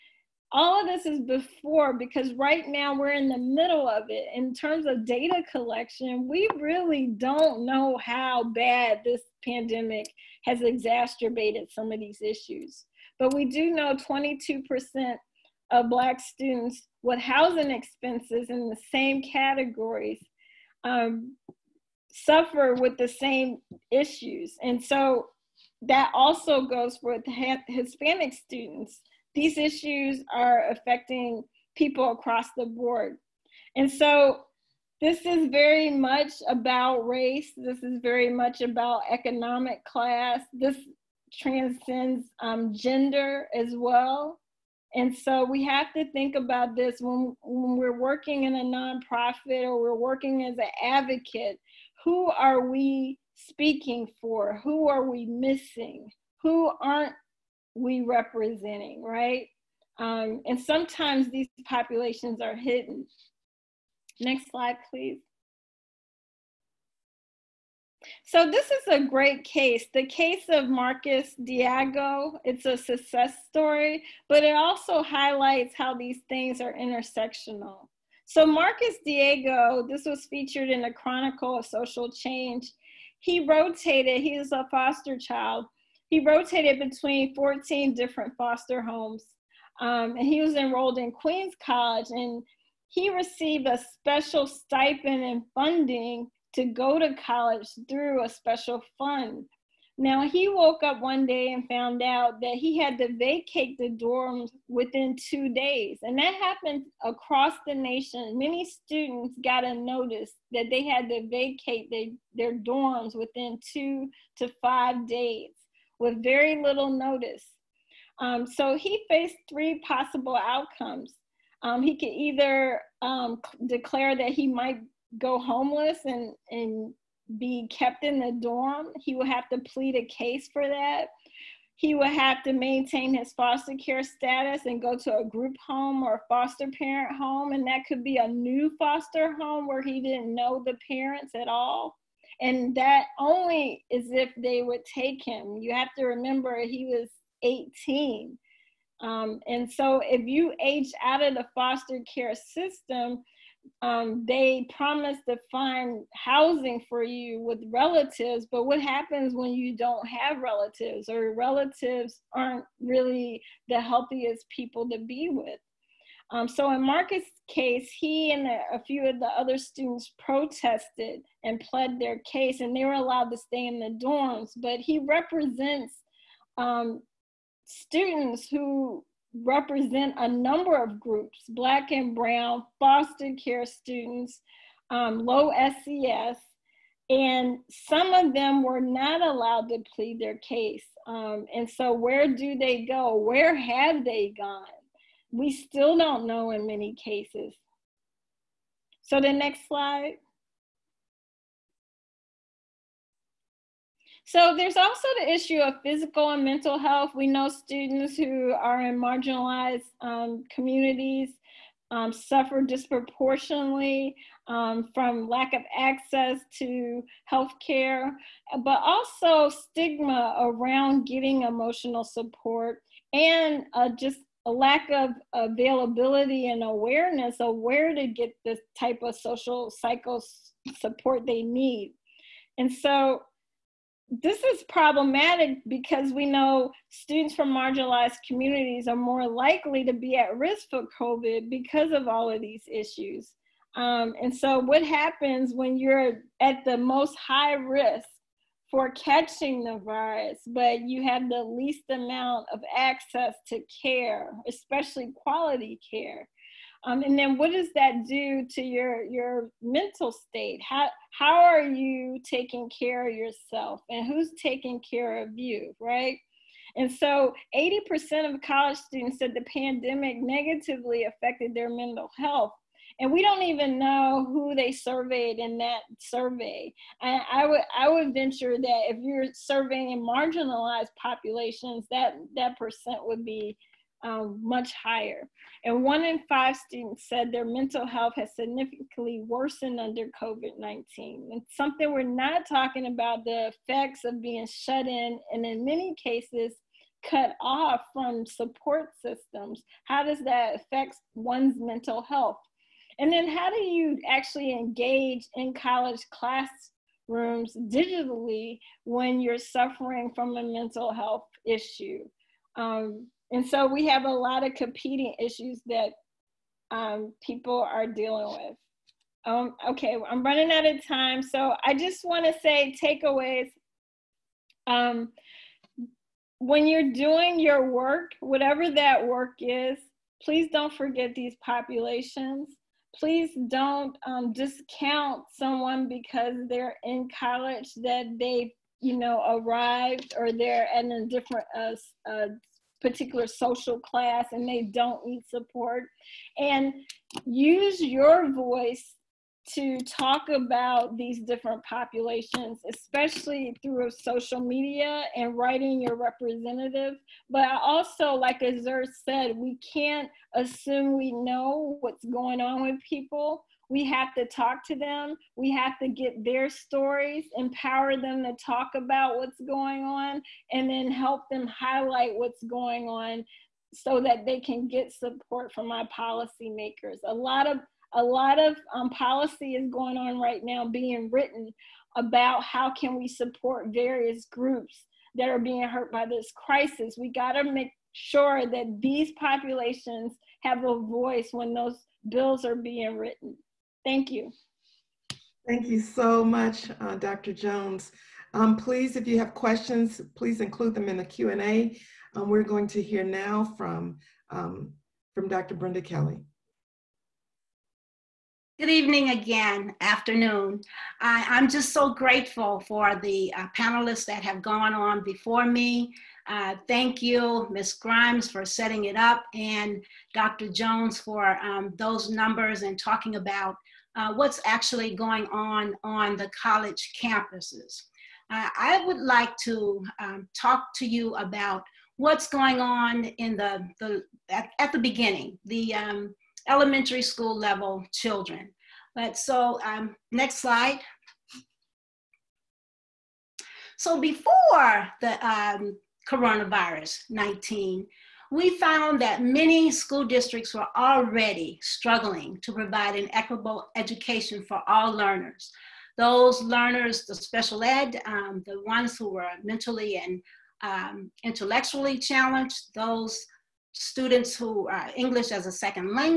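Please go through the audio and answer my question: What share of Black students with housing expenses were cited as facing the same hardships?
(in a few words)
22%.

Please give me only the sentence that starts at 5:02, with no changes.
And then how do you actually engage in college classrooms digitally when you're suffering from a mental health issue?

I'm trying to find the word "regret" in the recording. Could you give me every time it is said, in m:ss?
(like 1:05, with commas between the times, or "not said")
not said.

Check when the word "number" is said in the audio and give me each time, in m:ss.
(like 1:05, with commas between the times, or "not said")
3:00, 7:02.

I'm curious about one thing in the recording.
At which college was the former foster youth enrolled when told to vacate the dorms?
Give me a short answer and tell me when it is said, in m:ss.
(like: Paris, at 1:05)
Queens College, at 1:31.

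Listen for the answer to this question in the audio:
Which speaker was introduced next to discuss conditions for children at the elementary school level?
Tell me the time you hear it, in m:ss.
6:45.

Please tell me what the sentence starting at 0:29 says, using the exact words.
These issues are affecting people across the board.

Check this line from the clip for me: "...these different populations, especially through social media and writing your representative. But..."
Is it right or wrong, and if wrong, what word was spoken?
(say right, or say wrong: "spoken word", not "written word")
right.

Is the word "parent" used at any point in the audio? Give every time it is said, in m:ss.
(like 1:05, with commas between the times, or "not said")
2:16, 2:20.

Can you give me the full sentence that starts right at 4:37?
I, I would I would venture that if you're surveying marginalized populations, that that percent would be um, much higher.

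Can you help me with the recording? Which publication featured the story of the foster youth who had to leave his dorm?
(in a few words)
Chronicle of Social Change.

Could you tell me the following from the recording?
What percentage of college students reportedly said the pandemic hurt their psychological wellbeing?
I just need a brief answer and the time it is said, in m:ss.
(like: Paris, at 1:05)
80%, at 4:27.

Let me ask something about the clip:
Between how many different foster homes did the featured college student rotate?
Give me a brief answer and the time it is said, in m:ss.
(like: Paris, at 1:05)
14, at 1:27.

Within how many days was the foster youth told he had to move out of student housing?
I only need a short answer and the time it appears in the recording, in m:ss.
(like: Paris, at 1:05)
2, at 1:45.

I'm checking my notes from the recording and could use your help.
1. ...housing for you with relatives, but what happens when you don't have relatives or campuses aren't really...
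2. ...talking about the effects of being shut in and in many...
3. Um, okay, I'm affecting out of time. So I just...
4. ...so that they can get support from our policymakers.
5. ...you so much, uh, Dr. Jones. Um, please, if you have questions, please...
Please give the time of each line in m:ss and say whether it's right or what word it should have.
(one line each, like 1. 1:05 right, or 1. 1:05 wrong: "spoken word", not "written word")
1. 2:36 wrong: "relatives", not "campuses"
2. 4:52 right
3. 5:19 wrong: "running", not "affecting"
4. 6:13 right
5. 6:35 right.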